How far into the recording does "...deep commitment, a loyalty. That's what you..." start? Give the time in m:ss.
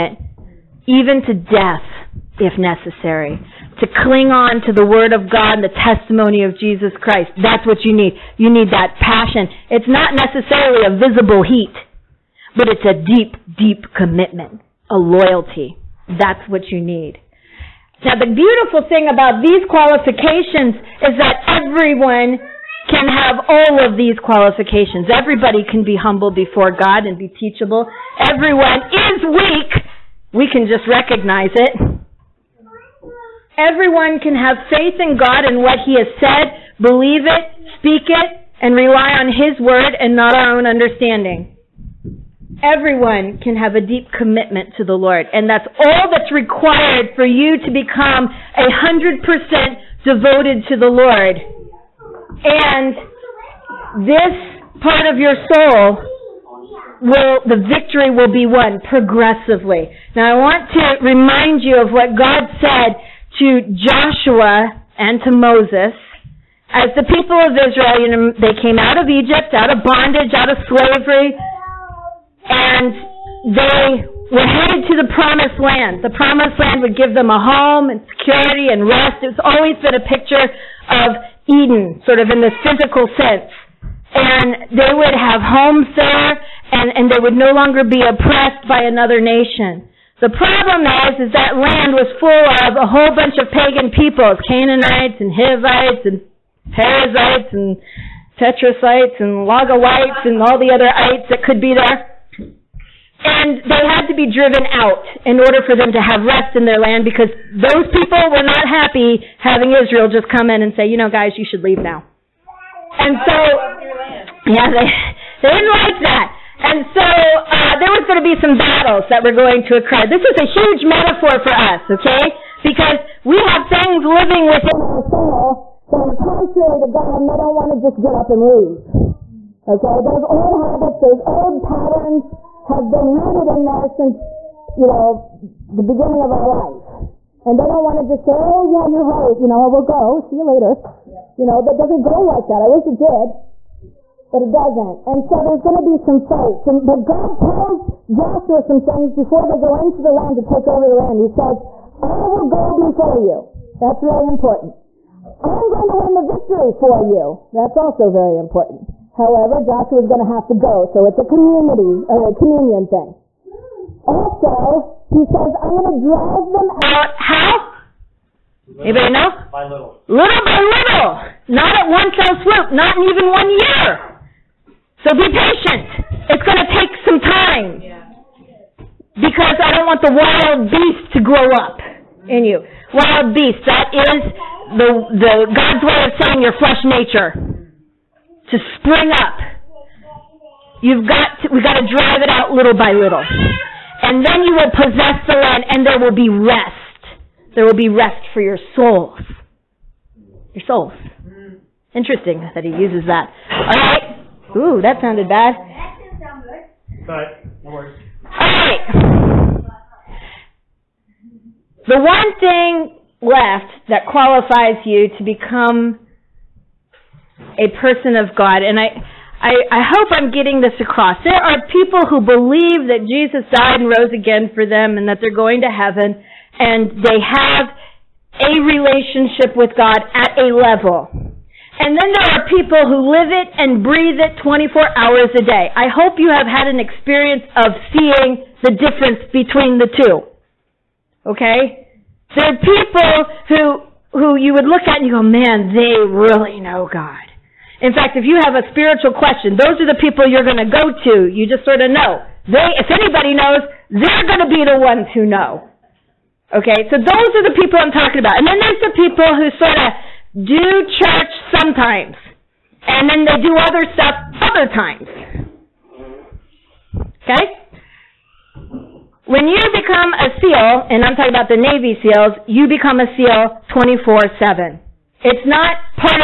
0:13.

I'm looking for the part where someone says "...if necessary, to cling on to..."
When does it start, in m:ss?
0:02.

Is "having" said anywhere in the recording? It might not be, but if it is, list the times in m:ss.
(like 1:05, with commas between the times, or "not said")
1:49.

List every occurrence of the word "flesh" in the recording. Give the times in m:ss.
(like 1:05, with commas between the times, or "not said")
3:06.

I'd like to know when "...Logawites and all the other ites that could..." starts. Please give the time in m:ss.
1:39.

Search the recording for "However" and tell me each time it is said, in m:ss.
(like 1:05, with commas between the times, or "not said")
2:39.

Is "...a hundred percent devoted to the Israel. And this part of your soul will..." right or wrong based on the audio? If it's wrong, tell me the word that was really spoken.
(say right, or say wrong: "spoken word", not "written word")
wrong: "Lord", not "Israel".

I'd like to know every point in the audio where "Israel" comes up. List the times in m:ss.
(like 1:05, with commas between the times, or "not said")
1:07, 1:49.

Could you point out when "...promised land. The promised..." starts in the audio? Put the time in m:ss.
1:15.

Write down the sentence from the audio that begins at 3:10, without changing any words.
You've got to, we've got to drive it out little by little.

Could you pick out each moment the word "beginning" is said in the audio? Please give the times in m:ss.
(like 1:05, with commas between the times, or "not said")
2:15.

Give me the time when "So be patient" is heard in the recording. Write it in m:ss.
2:55.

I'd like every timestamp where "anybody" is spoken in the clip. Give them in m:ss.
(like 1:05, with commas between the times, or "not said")
2:48, 4:12.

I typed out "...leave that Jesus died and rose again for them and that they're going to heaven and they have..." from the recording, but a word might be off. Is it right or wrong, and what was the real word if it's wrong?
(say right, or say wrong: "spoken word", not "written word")
wrong: "believe", not "leave".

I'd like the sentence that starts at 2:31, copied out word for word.
He says, I will go before you.